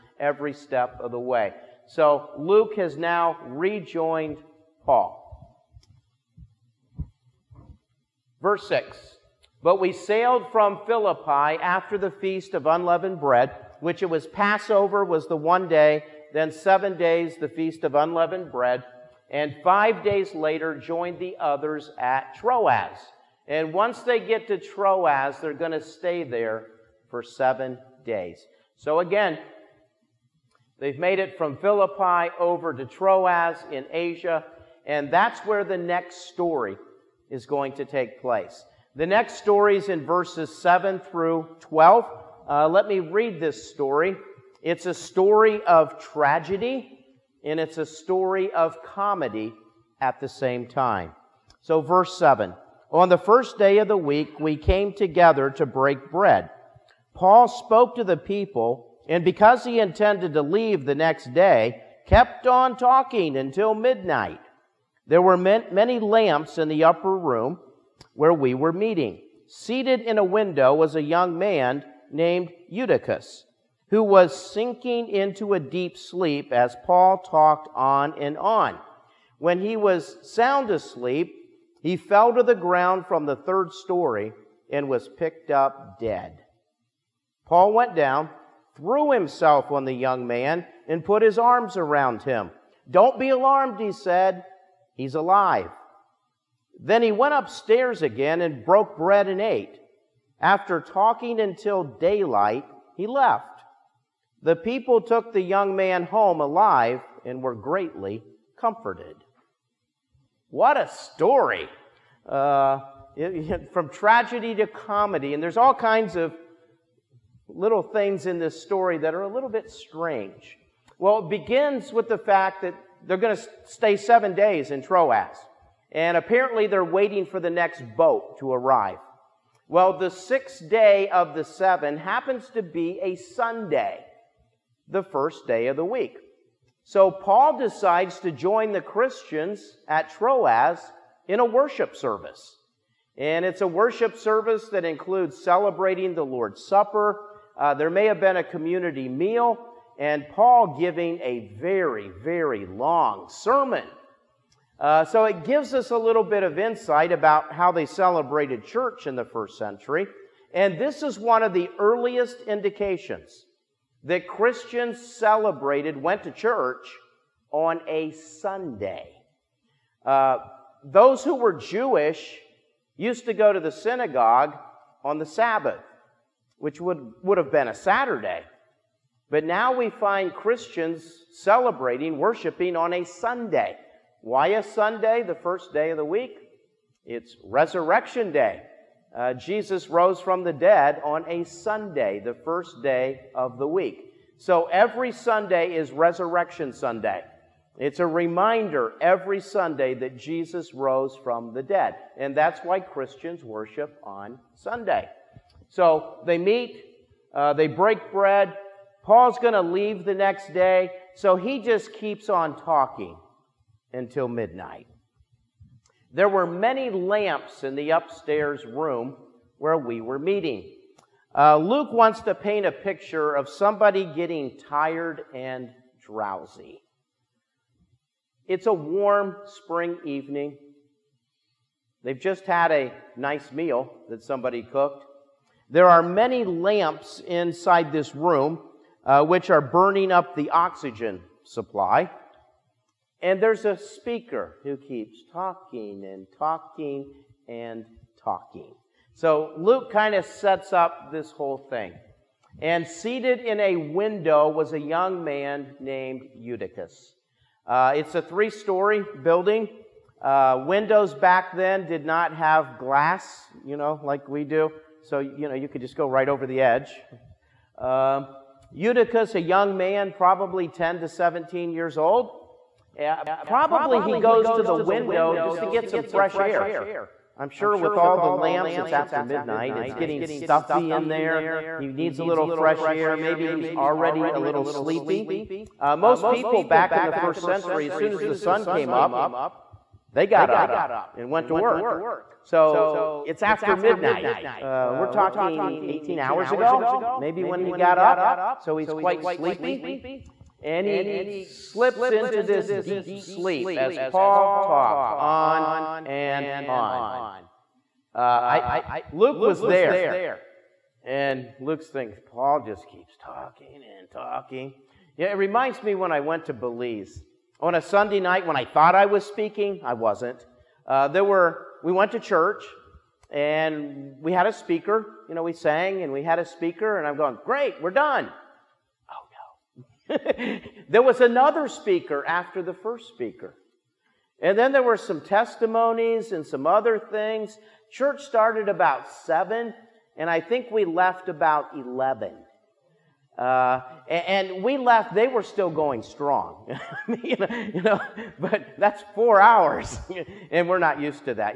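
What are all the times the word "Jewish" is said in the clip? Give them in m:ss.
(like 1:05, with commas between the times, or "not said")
2:51.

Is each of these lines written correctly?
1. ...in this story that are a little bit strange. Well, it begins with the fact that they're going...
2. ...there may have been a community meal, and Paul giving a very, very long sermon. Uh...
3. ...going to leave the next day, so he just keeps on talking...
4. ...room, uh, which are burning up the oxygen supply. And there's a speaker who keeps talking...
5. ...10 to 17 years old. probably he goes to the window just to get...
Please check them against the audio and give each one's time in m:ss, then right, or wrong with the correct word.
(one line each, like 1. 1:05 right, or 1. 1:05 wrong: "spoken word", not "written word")
1. 1:58 right
2. 2:27 right
3. 3:29 right
4. 3:58 right
5. 4:30 right.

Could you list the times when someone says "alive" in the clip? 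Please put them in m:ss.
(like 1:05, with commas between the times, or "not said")
1:35, 1:46.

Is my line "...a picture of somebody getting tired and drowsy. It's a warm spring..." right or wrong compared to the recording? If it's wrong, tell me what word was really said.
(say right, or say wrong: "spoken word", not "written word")
right.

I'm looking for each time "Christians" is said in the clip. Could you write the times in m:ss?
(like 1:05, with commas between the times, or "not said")
2:18, 2:44, 3:00, 3:22.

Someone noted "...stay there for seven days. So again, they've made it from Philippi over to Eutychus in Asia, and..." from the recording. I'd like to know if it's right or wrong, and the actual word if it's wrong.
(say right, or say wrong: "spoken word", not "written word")
wrong: "Troas", not "Eutychus".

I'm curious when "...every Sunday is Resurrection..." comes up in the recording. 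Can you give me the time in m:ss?
3:14.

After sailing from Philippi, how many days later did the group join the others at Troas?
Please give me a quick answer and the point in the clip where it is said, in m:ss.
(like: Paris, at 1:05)
5, at 0:19.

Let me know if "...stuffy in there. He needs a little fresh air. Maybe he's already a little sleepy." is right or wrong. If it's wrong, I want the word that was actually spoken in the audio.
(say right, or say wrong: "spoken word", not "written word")
right.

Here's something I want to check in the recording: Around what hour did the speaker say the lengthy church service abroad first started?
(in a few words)
7.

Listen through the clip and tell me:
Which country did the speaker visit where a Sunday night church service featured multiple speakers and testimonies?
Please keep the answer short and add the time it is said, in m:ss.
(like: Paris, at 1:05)
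Belize, at 5:16.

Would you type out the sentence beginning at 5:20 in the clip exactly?
Uh, there were, we went to church and we had a speaker.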